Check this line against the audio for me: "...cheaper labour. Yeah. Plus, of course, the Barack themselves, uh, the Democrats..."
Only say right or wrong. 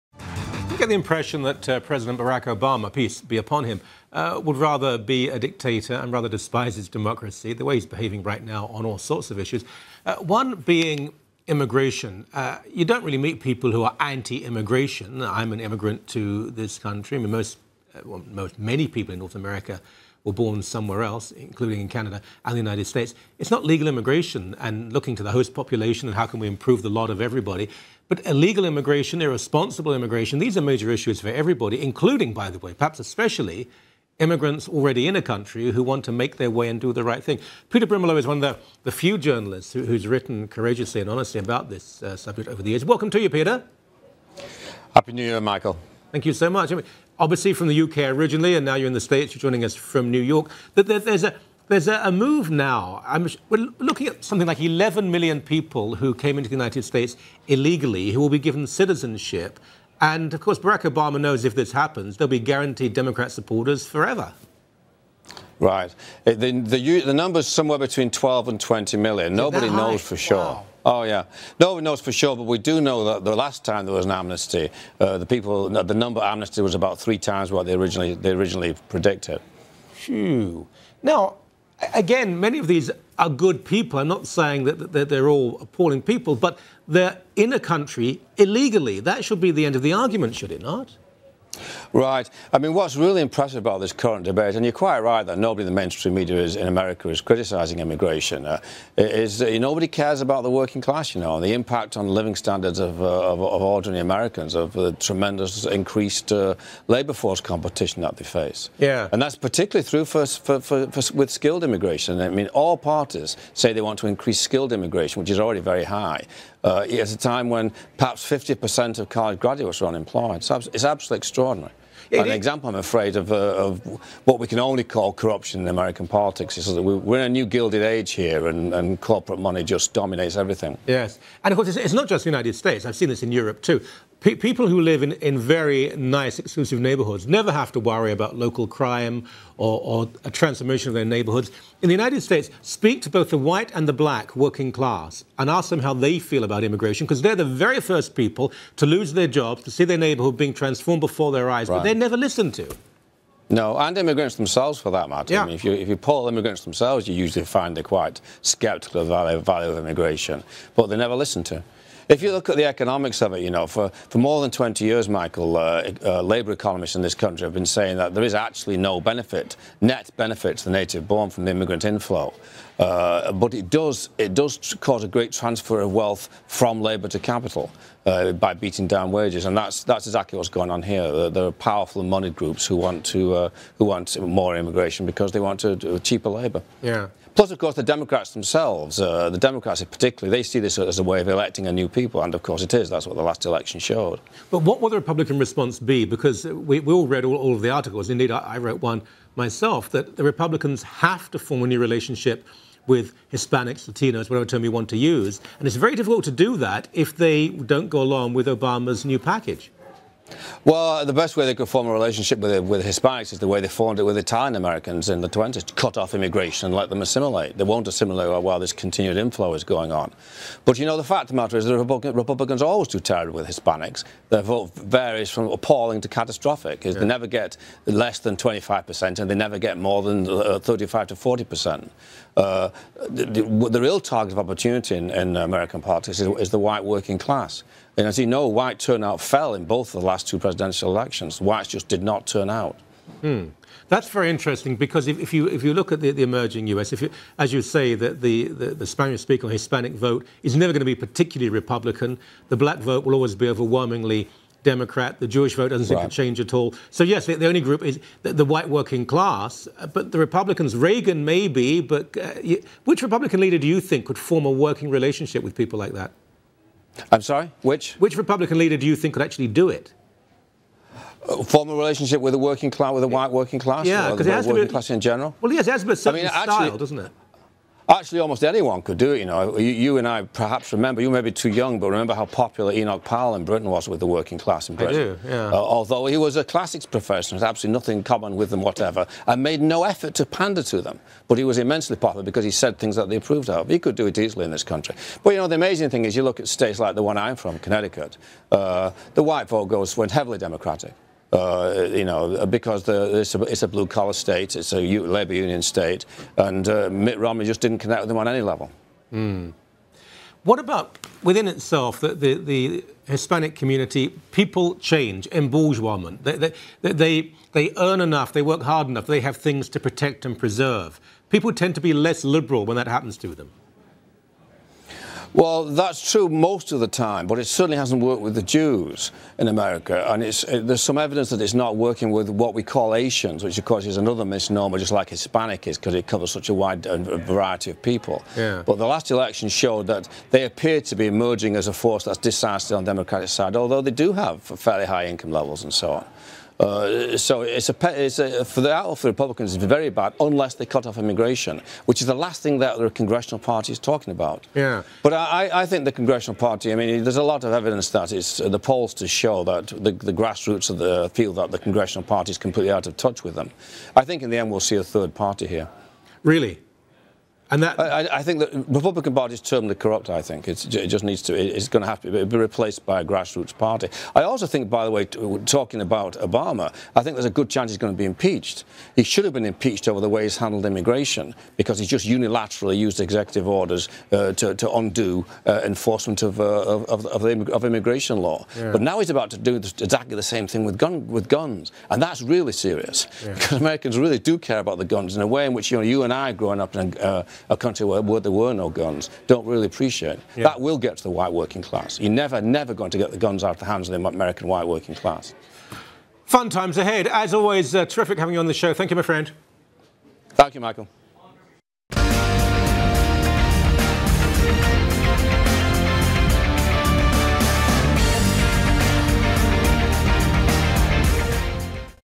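wrong.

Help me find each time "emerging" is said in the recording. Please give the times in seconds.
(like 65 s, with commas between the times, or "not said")
246 s, 341 s.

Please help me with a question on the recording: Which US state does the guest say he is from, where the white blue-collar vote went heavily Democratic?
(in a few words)
Connecticut.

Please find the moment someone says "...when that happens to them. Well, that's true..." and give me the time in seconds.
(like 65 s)
322 s.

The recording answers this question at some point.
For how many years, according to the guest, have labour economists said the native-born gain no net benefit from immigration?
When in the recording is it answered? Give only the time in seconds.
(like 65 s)
164 s.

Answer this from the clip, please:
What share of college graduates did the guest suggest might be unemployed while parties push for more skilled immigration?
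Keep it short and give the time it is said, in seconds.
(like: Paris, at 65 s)
50%, at 118 s.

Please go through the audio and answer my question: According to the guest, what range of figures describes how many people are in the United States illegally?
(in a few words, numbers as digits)
12 to 20 million.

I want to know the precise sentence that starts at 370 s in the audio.
I think it's, it just needs to.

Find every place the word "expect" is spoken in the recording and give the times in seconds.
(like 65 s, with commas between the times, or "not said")
not said.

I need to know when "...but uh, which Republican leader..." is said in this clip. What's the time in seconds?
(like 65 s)
261 s.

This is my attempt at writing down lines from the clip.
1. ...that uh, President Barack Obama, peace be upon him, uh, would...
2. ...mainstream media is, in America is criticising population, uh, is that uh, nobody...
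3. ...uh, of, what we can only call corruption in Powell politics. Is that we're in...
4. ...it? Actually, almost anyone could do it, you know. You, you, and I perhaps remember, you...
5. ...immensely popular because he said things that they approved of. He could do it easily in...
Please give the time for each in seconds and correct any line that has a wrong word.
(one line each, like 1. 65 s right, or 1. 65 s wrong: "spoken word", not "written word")
1. 1 s right
2. 95 s wrong: "immigration", not "population"
3. 123 s wrong: "American", not "Powell"
4. 276 s right
5. 291 s right.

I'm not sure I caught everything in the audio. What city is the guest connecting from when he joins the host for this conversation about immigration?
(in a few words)
New York.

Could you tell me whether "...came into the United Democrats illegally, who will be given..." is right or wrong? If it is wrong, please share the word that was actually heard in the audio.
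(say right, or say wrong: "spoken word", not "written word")
wrong: "States", not "Democrats".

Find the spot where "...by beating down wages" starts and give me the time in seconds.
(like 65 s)
178 s.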